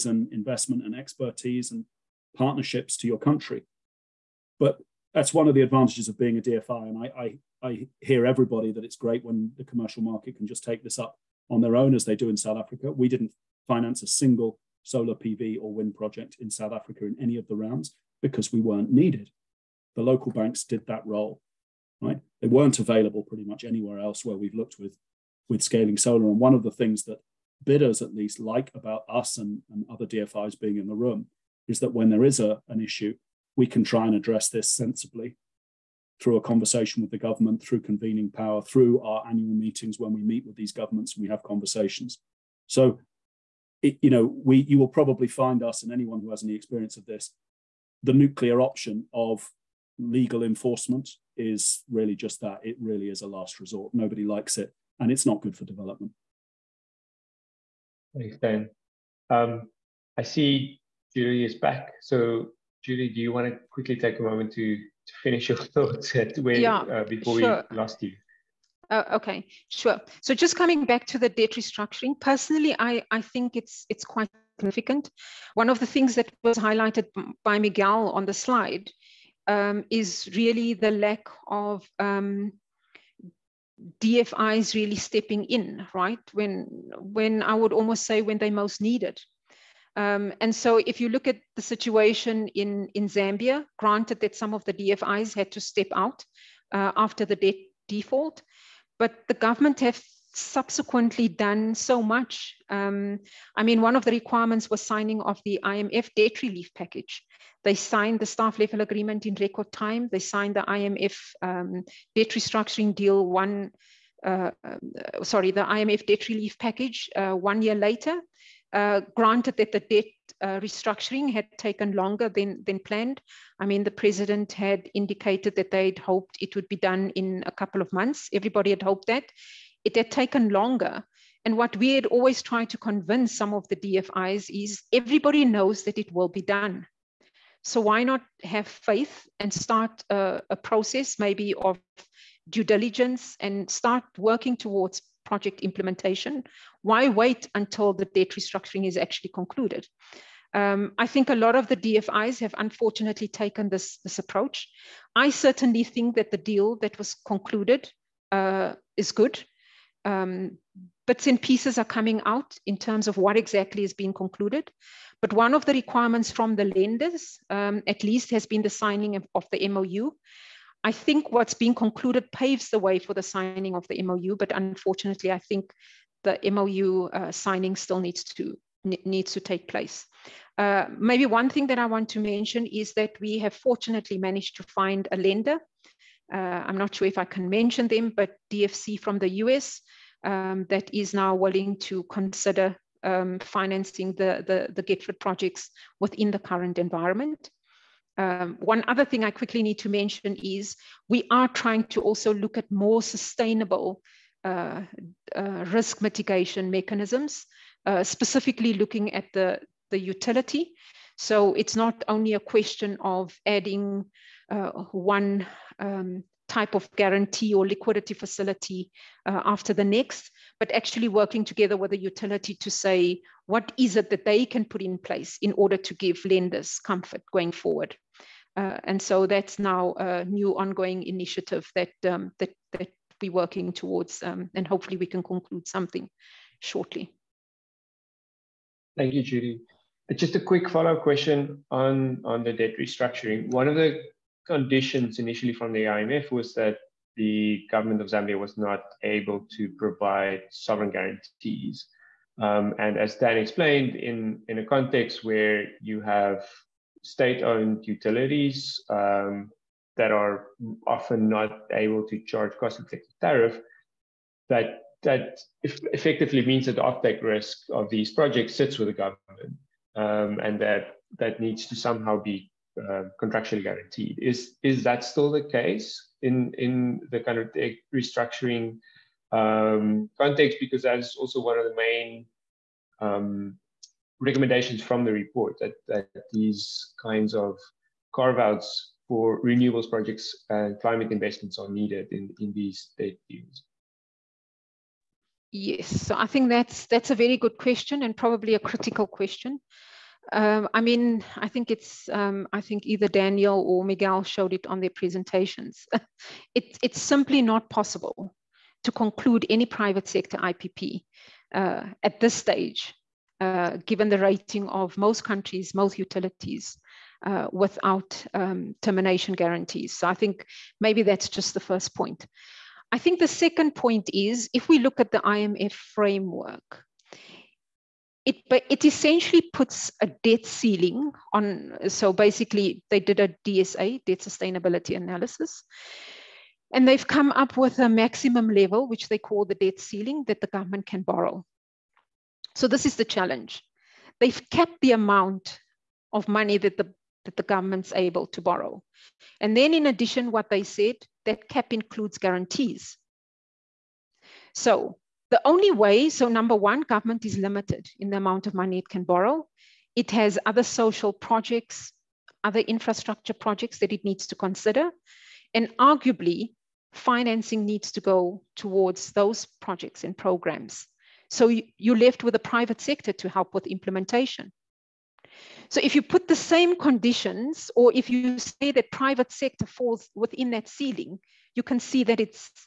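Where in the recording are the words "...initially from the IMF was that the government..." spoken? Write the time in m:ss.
4:05.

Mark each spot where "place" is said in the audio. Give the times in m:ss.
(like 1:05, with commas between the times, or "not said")
2:59, 3:44.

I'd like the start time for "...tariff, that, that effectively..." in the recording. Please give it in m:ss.
4:23.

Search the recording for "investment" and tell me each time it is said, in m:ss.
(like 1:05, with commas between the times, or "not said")
0:00, 4:51.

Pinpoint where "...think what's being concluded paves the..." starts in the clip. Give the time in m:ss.
2:50.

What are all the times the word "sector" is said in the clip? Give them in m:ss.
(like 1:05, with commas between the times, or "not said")
5:10, 6:12, 6:19.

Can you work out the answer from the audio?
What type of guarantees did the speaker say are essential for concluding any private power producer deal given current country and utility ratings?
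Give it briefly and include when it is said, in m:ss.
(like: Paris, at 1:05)
Termination guarantees, at 5:18.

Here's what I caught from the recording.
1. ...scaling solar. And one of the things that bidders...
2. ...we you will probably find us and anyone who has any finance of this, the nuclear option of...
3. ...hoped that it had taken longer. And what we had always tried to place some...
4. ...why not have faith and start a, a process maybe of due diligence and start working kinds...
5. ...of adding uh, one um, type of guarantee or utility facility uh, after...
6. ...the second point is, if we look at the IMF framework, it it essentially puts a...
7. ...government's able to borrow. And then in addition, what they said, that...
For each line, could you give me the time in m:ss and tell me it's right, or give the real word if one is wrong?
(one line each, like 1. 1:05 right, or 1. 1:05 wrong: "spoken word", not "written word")
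1. 0:25 right
2. 0:44 wrong: "experience", not "finance"
3. 2:08 wrong: "convince", not "place"
4. 2:17 wrong: "towards", not "kinds"
5. 3:32 wrong: "liquidity", not "utility"
6. 5:23 right
7. 5:47 right.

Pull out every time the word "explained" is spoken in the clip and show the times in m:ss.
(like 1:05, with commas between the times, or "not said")
4:13.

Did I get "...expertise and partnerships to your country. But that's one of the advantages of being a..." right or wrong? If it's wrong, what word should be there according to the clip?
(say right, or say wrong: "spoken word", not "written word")
right.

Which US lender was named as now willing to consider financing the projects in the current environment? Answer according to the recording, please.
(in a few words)
DFC.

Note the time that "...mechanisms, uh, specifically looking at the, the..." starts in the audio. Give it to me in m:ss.
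3:26.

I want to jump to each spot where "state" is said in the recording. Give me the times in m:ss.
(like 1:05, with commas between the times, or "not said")
4:17, 4:52.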